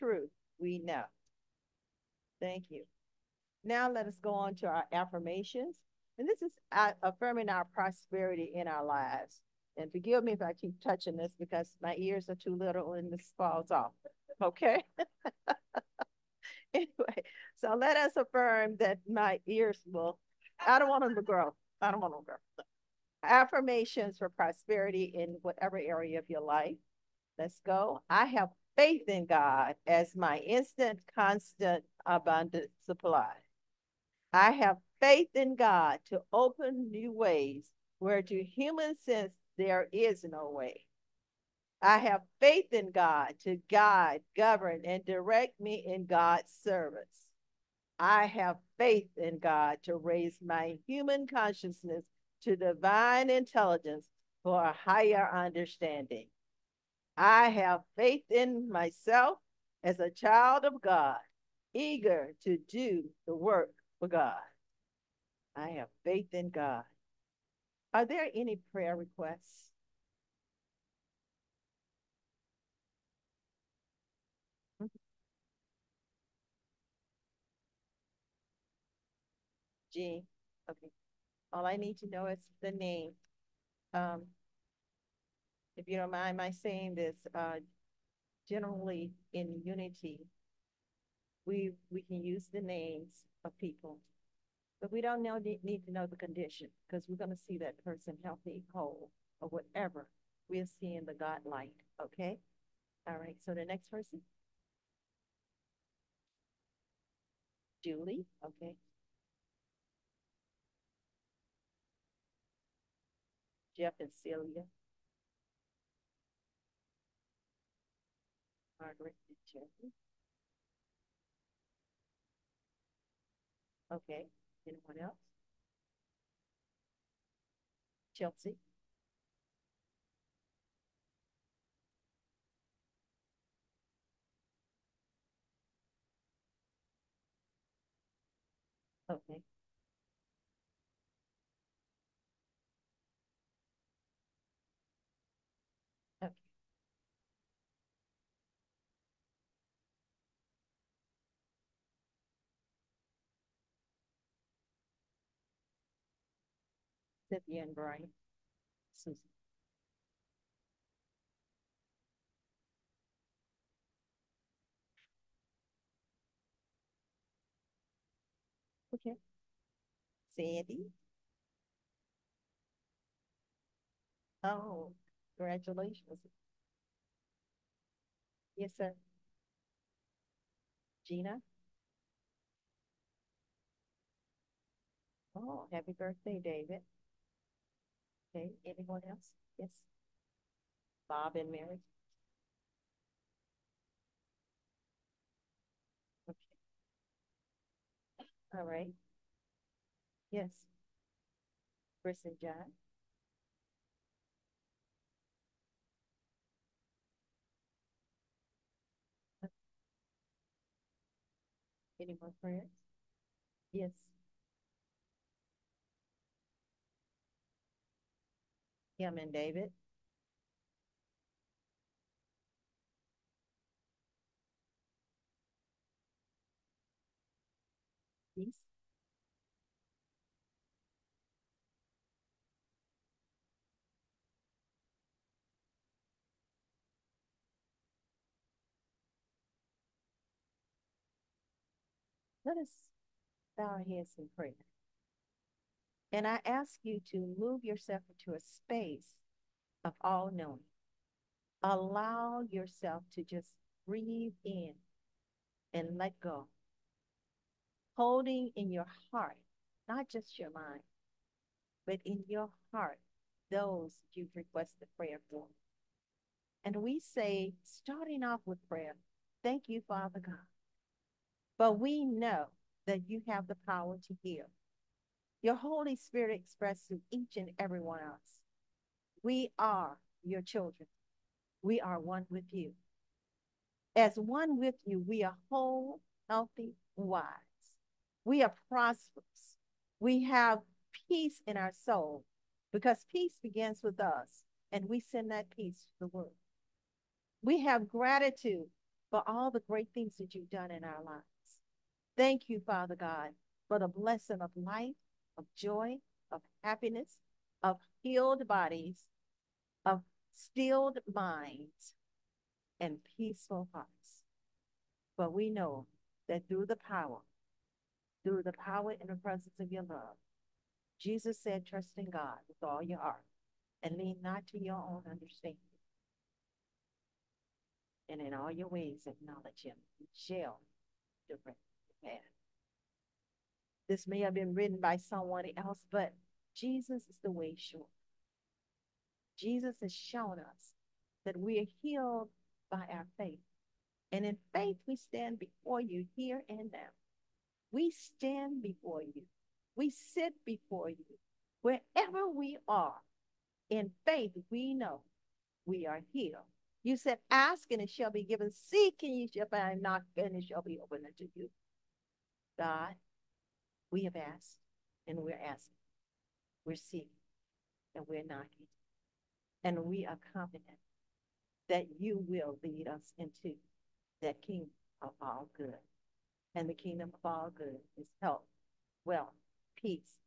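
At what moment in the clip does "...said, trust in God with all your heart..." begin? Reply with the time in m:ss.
5:21.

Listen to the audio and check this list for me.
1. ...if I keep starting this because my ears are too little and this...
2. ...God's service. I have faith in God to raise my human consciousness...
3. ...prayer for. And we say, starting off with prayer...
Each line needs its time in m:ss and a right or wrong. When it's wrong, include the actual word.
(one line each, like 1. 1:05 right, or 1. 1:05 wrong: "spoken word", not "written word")
1. 0:10 wrong: "touching", not "starting"
2. 0:46 right
3. 4:24 right.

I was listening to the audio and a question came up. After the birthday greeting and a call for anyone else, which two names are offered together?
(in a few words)
Bob and Mary.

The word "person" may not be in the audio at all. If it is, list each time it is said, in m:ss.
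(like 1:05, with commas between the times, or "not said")
1:37, 1:43.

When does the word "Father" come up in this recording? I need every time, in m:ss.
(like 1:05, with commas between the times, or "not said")
4:29, 5:02.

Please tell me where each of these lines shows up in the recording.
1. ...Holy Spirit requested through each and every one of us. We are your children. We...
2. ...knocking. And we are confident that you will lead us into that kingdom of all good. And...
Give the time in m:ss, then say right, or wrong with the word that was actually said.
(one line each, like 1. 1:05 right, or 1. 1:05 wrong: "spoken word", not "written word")
1. 4:35 wrong: "expressed", not "requested"
2. 6:08 right.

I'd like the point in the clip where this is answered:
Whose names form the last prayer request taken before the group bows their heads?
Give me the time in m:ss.
3:38.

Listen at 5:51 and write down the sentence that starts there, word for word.
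Wherever we are, in faith, we know we are healed.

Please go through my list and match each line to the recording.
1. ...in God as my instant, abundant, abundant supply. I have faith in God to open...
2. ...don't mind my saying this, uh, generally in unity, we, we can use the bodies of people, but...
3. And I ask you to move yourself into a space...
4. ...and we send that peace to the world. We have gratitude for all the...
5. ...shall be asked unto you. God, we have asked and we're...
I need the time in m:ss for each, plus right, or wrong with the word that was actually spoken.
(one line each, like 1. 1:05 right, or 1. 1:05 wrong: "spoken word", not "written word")
1. 0:29 wrong: "constant", not "abundant"
2. 1:25 wrong: "names", not "bodies"
3. 4:06 right
4. 4:54 right
5. 6:00 wrong: "opened", not "asked".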